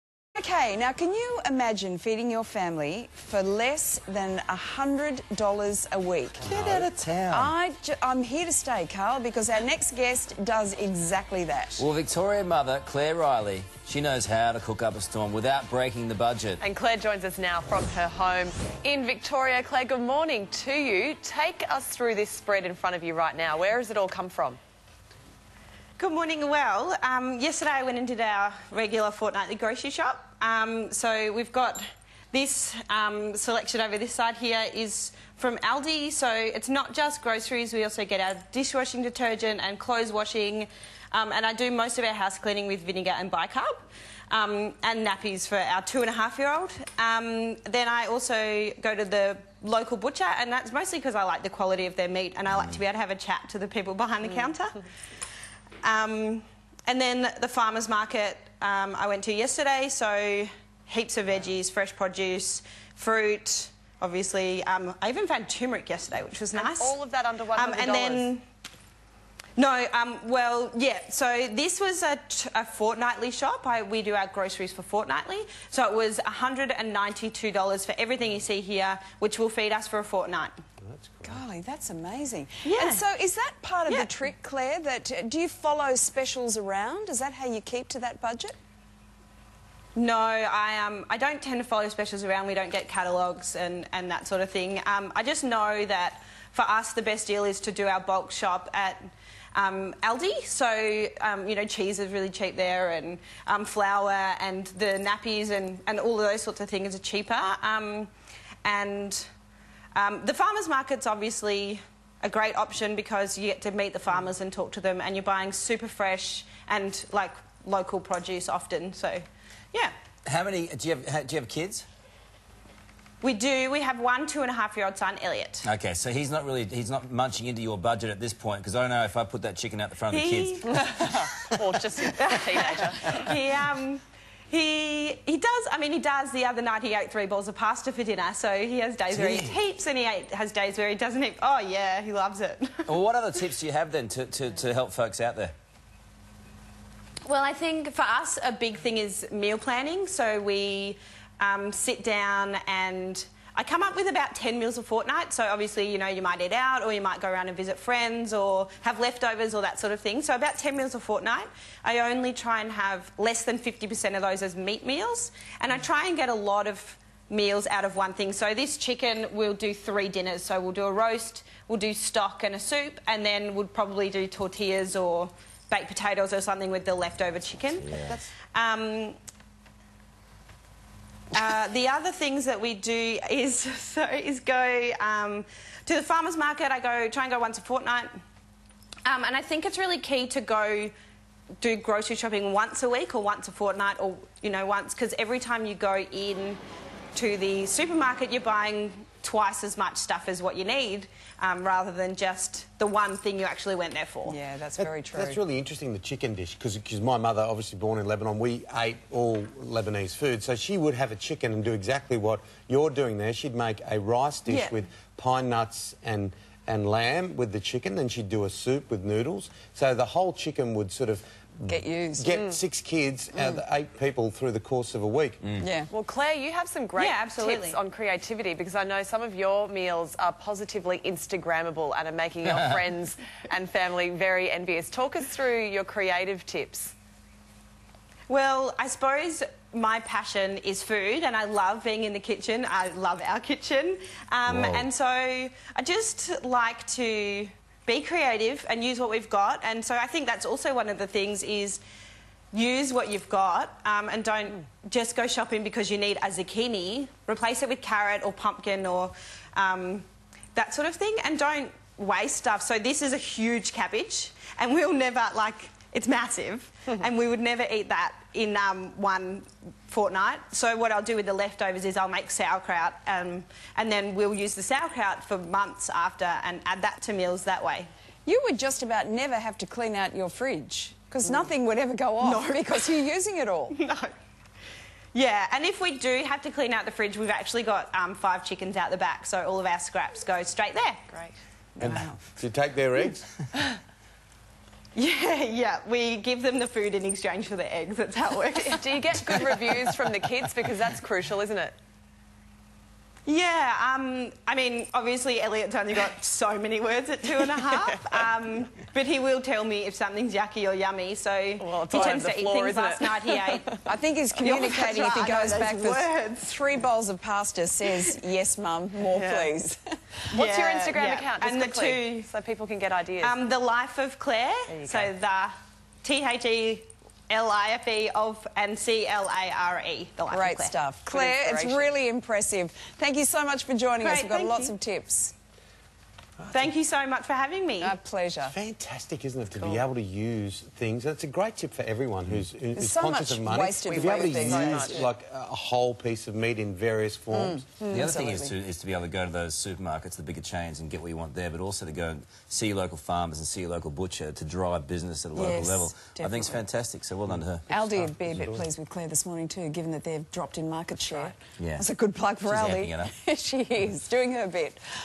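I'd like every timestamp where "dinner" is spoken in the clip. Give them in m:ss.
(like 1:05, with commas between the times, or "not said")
2:18, 2:50.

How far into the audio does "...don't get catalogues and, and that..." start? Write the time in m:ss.
1:32.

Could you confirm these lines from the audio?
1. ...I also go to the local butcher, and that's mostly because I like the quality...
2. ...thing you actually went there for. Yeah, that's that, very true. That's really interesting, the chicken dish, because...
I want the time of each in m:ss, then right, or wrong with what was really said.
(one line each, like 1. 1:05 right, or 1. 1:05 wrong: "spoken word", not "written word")
1. 0:47 right
2. 3:23 right.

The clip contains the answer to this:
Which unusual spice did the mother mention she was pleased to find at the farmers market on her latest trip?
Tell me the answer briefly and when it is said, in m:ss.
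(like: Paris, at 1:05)
turmeric, at 1:05.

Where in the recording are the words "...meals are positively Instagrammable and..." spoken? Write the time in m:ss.
3:49.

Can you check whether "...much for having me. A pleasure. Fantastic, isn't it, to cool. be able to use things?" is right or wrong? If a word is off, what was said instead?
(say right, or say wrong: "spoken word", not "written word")
right.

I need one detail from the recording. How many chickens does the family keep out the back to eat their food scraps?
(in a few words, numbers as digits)
5.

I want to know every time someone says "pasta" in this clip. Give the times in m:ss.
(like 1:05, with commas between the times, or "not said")
2:17, 5:17.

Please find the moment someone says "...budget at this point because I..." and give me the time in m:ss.
2:07.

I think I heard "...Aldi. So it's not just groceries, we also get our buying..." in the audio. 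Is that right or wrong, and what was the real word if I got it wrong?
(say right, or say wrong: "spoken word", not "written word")
wrong: "dishwashing", not "buying".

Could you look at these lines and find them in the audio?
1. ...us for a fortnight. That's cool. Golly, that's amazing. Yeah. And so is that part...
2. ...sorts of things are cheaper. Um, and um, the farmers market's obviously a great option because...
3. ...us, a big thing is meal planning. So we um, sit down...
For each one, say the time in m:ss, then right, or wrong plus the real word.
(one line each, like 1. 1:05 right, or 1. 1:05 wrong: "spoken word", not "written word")
1. 1:19 right
2. 1:46 right
3. 2:28 right.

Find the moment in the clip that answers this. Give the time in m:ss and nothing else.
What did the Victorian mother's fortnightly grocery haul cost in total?
1:16.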